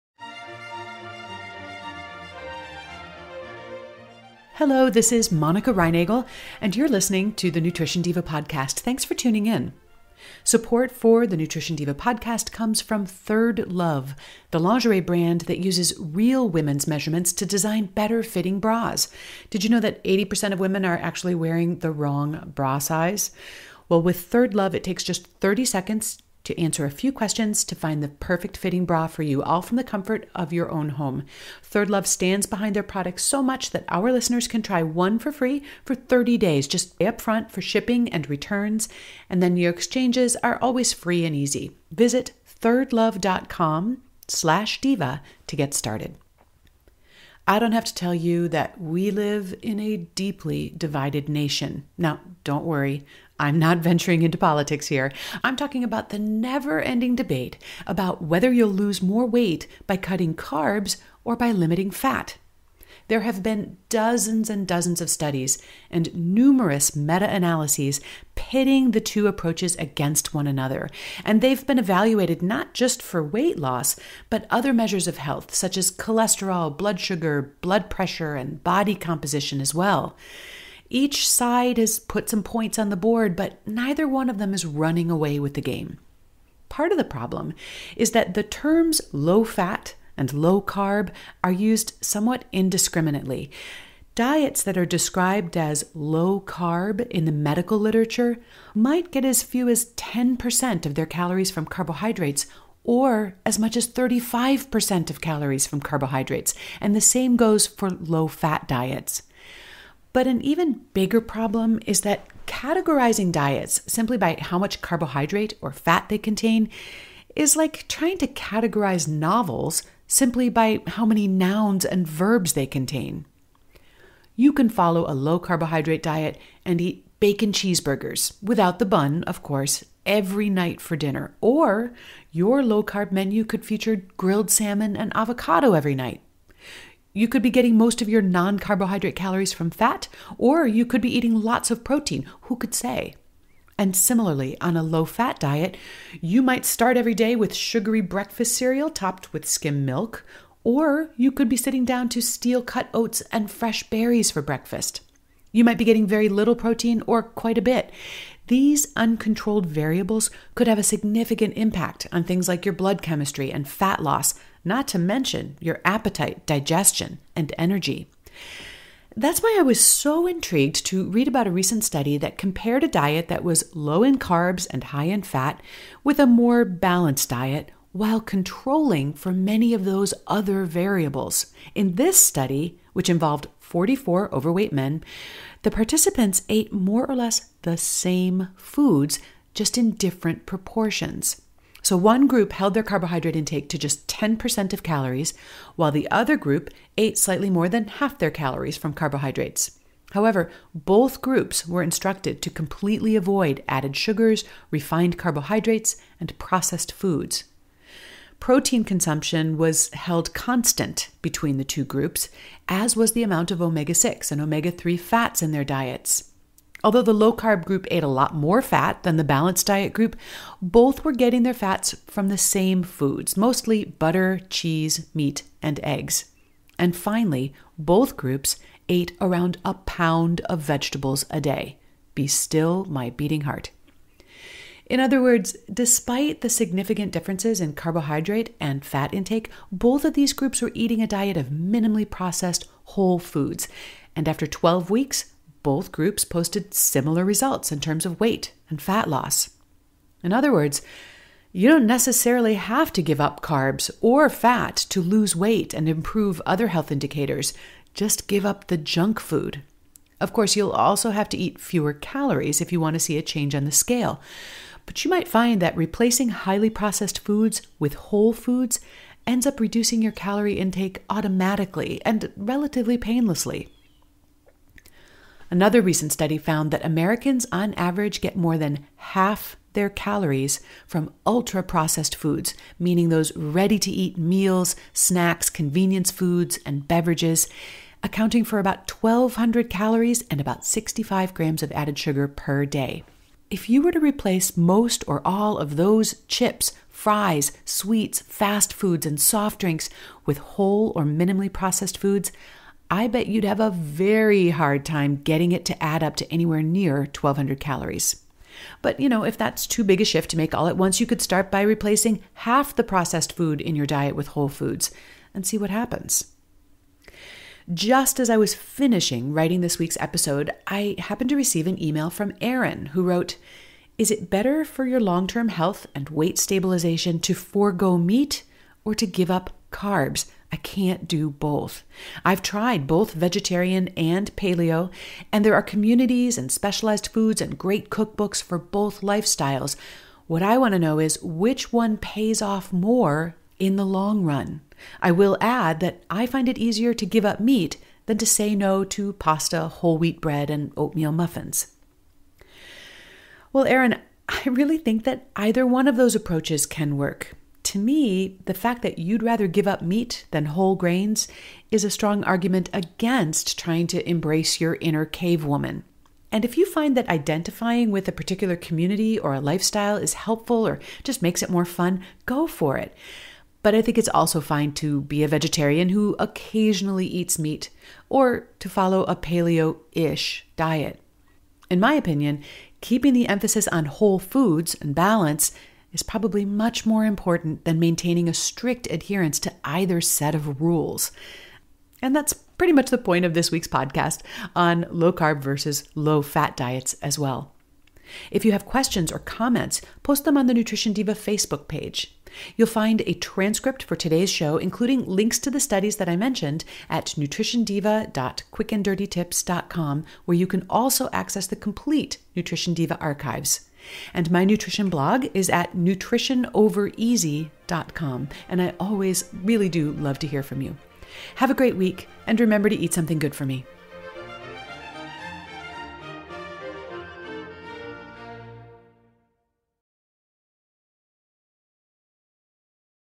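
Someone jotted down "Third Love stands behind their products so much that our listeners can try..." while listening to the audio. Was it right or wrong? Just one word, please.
right.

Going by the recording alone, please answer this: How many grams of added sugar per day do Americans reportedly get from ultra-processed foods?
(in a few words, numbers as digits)
65 grams.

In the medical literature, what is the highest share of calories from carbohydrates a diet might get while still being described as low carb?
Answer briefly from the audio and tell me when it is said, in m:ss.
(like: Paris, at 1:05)
35%, at 1:43.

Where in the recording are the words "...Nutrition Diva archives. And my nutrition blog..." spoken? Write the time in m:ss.
6:52.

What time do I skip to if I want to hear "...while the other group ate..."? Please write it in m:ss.
3:15.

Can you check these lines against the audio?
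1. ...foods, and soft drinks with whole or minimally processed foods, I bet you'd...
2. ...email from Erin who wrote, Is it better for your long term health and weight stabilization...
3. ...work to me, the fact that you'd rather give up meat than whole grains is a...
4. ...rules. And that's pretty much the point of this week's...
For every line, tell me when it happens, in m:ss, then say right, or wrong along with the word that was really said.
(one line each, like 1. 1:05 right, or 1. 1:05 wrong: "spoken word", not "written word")
1. 4:58 right
2. 5:21 right
3. 5:56 right
4. 6:30 right.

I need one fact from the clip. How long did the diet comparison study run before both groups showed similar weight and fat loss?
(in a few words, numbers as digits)
12 weeks.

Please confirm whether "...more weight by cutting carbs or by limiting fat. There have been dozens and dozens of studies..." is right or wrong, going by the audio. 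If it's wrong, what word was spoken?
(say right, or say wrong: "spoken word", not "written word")
right.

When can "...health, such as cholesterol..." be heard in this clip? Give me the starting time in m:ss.
1:15.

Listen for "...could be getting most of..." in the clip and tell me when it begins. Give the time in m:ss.
2:17.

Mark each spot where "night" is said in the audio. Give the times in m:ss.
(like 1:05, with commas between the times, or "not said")
2:10, 2:15.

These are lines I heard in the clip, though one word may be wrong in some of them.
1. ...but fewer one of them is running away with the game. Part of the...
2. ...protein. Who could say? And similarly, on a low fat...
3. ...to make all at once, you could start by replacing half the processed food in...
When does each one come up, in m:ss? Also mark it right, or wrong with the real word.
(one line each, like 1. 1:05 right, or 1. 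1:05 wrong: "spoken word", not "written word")
1. 1:23 wrong: "neither", not "fewer"
2. 2:21 right
3. 5:10 right.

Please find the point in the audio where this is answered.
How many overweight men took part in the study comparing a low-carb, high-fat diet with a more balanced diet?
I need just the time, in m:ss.
3:03.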